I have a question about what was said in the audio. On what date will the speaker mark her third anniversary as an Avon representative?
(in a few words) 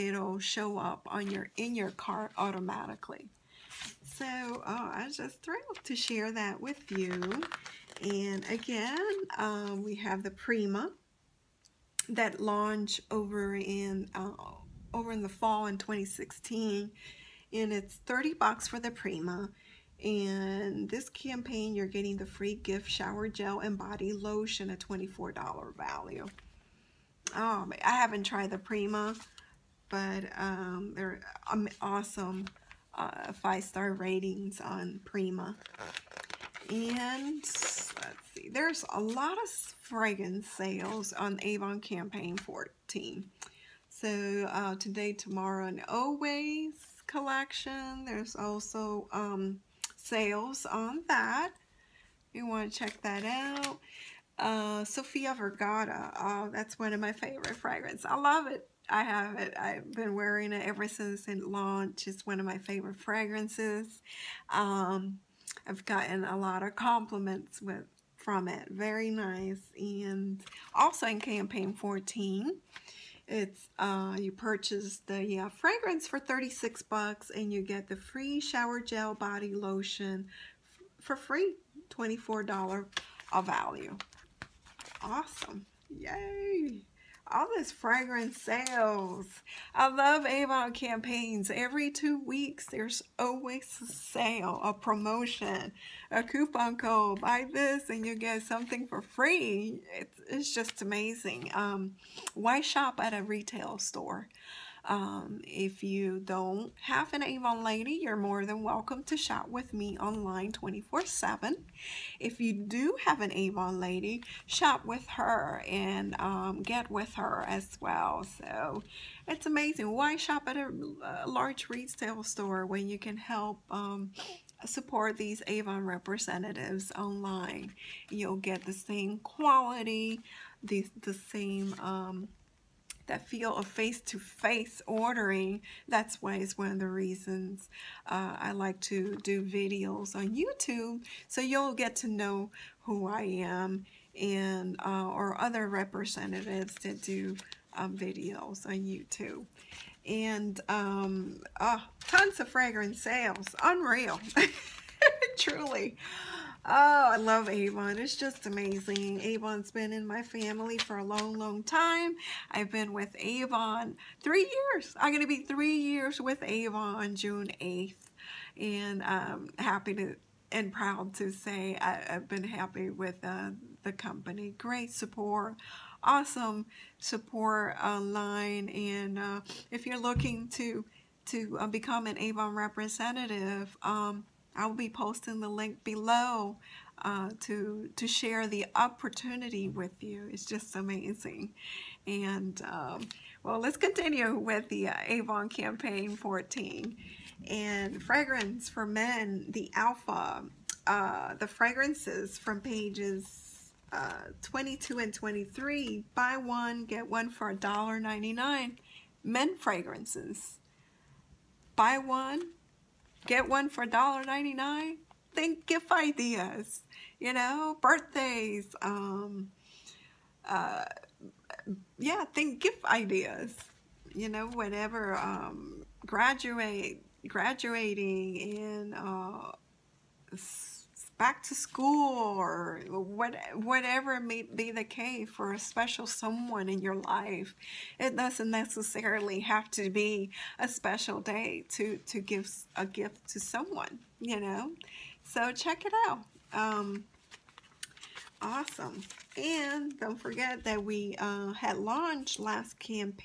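June 8th.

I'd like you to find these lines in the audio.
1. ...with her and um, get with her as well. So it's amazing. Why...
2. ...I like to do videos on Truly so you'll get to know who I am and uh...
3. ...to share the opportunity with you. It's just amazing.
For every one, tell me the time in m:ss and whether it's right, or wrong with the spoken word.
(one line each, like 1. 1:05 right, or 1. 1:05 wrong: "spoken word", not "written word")
1. 1:54 right
2. 2:18 wrong: "YouTube", not "Truly"
3. 3:07 right.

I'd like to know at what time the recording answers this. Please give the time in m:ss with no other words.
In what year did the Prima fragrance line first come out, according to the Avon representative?
0:15.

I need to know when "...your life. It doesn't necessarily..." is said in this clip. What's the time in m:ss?
3:56.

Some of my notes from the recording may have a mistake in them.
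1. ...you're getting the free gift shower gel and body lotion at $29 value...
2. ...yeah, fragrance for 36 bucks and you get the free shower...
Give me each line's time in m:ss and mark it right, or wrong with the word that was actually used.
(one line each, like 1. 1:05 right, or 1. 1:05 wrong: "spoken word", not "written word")
1. 0:21 wrong: "24", not "29"
2. 1:15 right.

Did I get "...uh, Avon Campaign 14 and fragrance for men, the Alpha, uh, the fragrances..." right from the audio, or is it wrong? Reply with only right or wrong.
right.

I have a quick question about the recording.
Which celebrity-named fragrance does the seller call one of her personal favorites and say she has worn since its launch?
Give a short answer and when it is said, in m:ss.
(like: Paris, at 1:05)
Sofia Vergara, at 0:54.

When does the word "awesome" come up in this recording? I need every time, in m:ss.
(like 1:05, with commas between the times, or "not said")
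0:31, 1:25, 2:56, 4:08.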